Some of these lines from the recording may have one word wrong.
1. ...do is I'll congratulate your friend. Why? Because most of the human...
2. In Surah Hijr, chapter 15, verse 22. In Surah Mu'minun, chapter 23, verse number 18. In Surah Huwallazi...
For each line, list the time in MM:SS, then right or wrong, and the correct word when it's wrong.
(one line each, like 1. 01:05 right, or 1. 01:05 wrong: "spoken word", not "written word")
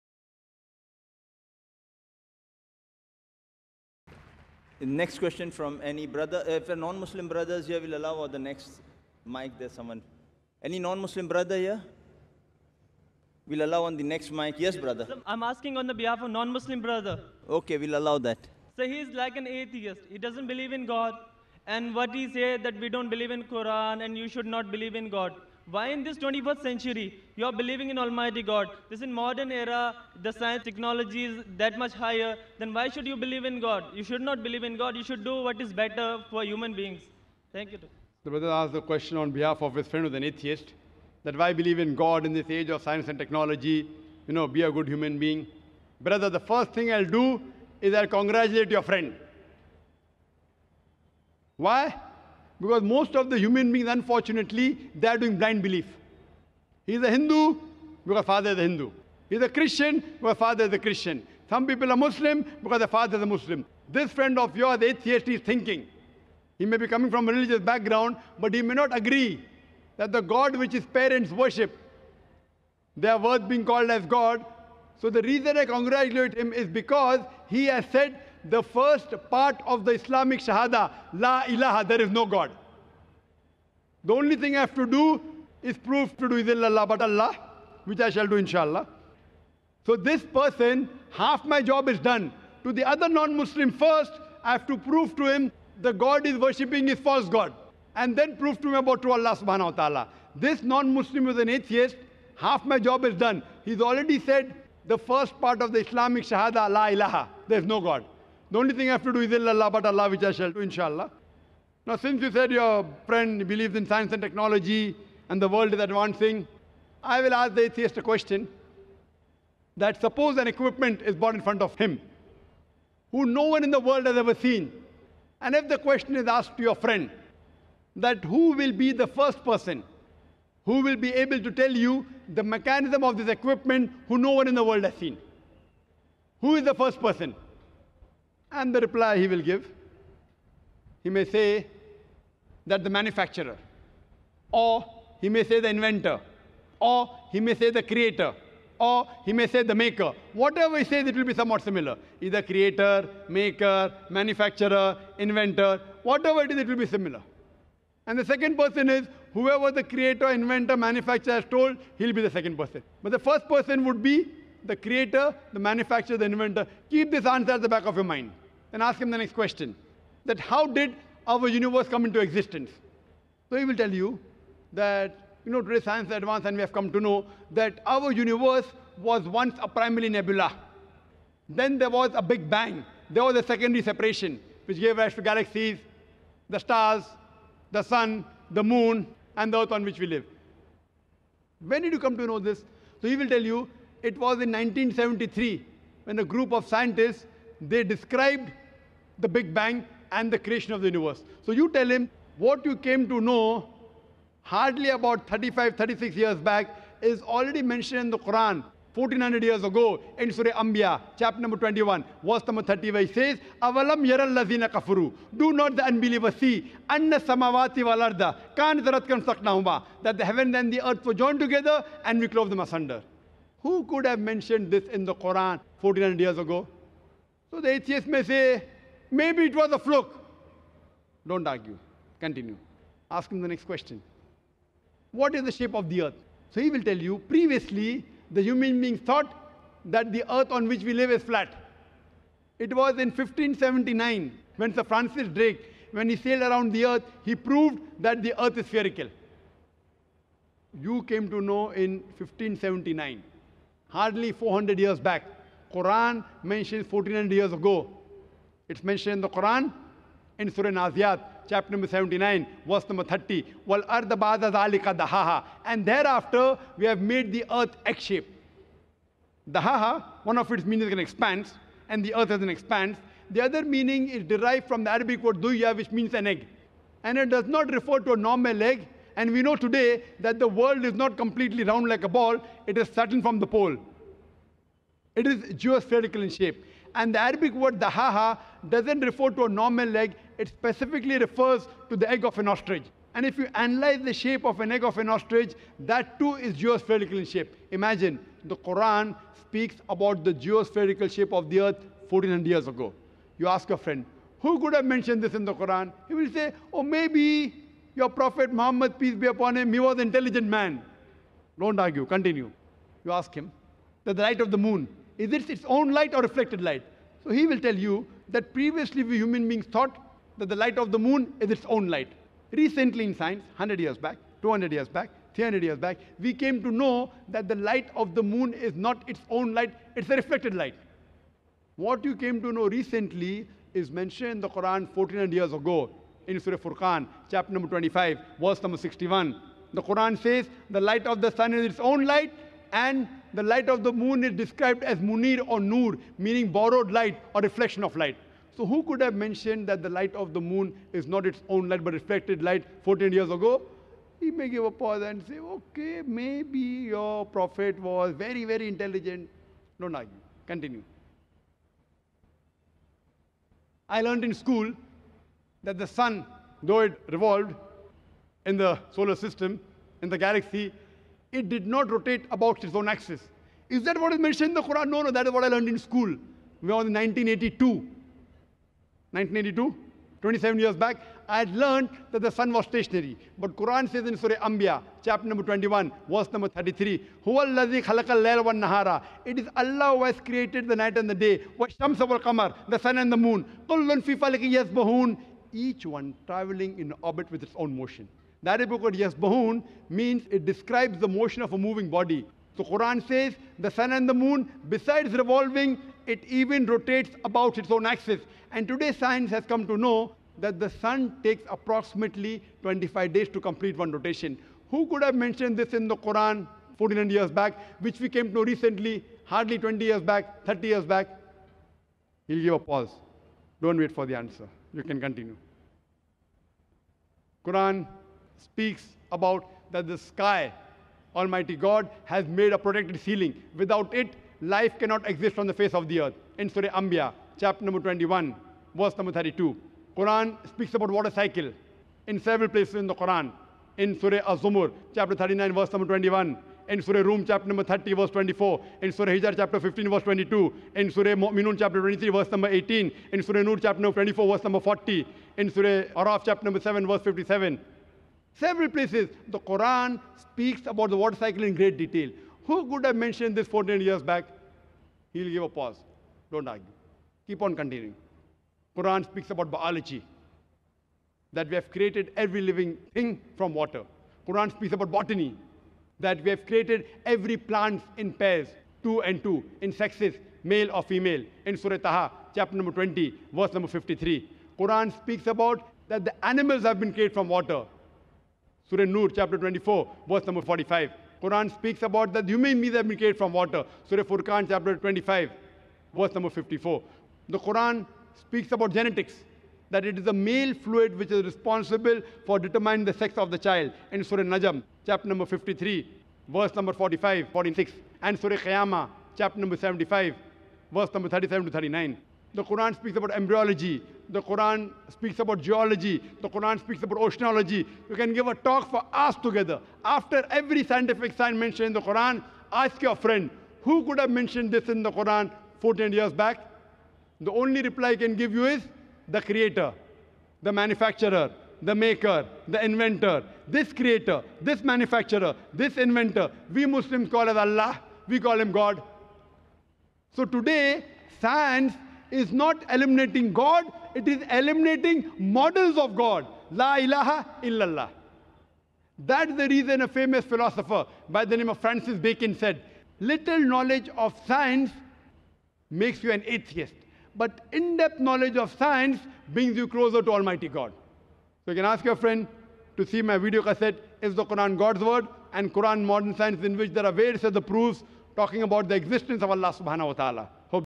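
1. 00:47 right
2. 07:28 wrong: "Nur", not "Huwallazi".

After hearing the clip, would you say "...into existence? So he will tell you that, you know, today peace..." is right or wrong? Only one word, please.
wrong.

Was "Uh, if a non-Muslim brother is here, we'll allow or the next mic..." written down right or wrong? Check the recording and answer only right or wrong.
right.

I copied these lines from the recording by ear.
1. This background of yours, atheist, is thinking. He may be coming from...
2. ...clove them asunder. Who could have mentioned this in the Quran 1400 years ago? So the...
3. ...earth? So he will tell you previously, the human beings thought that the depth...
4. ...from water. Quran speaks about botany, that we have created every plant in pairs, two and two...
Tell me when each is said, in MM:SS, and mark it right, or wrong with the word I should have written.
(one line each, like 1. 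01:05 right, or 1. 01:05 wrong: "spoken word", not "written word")
1. 01:03 wrong: "friend", not "background"
2. 03:42 right
3. 03:56 wrong: "earth", not "depth"
4. 07:53 right.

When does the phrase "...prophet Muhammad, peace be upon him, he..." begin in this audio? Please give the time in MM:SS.
05:08.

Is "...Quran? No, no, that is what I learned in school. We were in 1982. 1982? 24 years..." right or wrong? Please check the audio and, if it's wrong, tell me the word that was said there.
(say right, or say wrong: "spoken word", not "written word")
wrong: "27", not "24".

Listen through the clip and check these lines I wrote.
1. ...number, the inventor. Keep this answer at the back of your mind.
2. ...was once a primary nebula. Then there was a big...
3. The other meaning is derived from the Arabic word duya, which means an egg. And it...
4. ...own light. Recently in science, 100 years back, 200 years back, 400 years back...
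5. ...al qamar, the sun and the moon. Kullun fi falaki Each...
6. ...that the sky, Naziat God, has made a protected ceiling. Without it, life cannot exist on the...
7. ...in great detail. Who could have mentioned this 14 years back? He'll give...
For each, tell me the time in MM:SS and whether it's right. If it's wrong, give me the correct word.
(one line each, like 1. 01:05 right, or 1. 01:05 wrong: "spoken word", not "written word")
1. 02:45 wrong: "manufacturer", not "number"
2. 02:58 right
3. 04:33 right
4. 05:21 wrong: "300", not "400"
5. 06:32 right
6. 07:09 wrong: "Almighty", not "Naziat"
7. 07:41 right.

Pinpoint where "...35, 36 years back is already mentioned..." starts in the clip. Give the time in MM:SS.
03:25.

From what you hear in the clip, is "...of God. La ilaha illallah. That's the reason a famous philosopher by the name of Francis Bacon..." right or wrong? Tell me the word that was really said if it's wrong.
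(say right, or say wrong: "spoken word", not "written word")
right.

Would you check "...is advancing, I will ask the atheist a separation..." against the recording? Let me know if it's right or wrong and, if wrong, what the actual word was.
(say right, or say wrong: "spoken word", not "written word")
wrong: "question", not "separation".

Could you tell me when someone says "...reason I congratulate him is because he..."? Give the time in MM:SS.
01:15.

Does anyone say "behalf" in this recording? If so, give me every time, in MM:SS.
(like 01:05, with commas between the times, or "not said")
00:15, 00:39.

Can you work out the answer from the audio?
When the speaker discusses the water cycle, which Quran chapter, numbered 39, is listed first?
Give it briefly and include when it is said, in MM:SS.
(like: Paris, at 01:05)
Surah Az-Zumur, at 07:23.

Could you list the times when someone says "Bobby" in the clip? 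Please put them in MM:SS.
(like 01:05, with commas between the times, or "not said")
not said.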